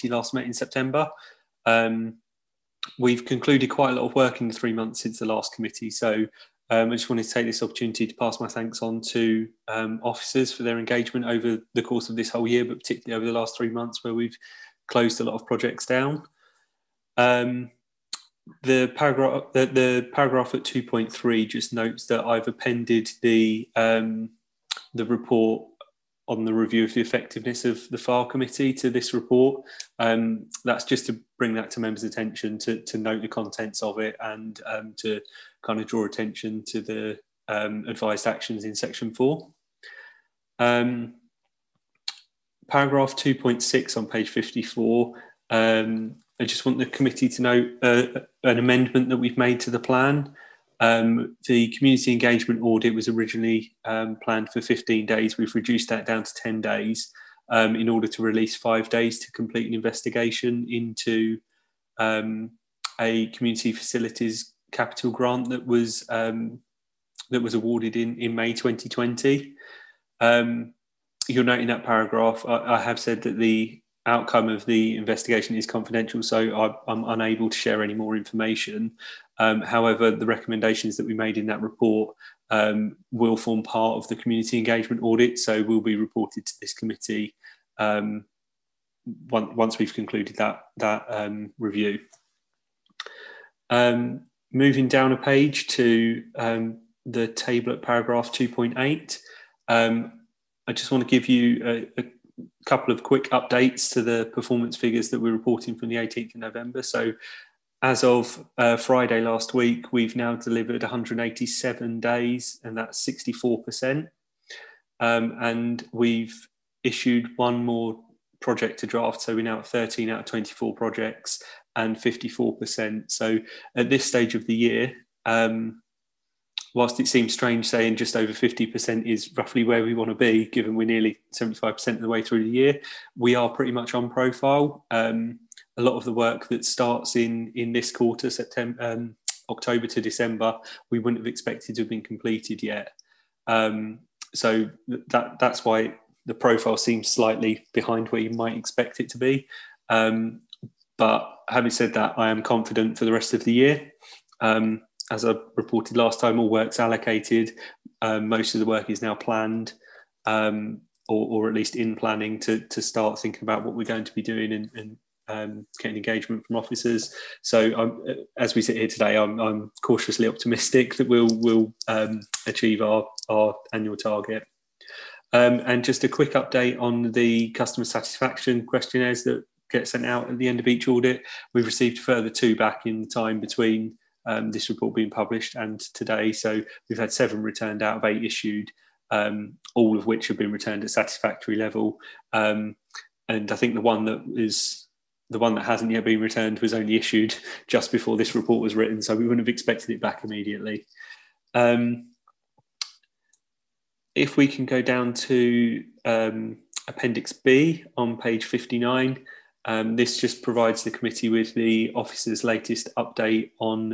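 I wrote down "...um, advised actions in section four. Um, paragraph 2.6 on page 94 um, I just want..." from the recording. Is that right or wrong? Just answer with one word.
wrong.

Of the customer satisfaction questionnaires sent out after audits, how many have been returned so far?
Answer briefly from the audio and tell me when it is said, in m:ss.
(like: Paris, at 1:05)
7, at 3:07.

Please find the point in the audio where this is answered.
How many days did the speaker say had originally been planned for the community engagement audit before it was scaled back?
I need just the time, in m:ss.
0:54.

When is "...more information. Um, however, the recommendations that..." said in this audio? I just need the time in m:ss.
1:17.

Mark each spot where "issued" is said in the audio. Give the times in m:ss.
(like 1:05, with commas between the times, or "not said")
1:56, 3:08, 3:16.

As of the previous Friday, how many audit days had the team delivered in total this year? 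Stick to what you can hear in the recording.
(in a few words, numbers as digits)
187.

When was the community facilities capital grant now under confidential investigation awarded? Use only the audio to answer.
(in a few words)
May 2020.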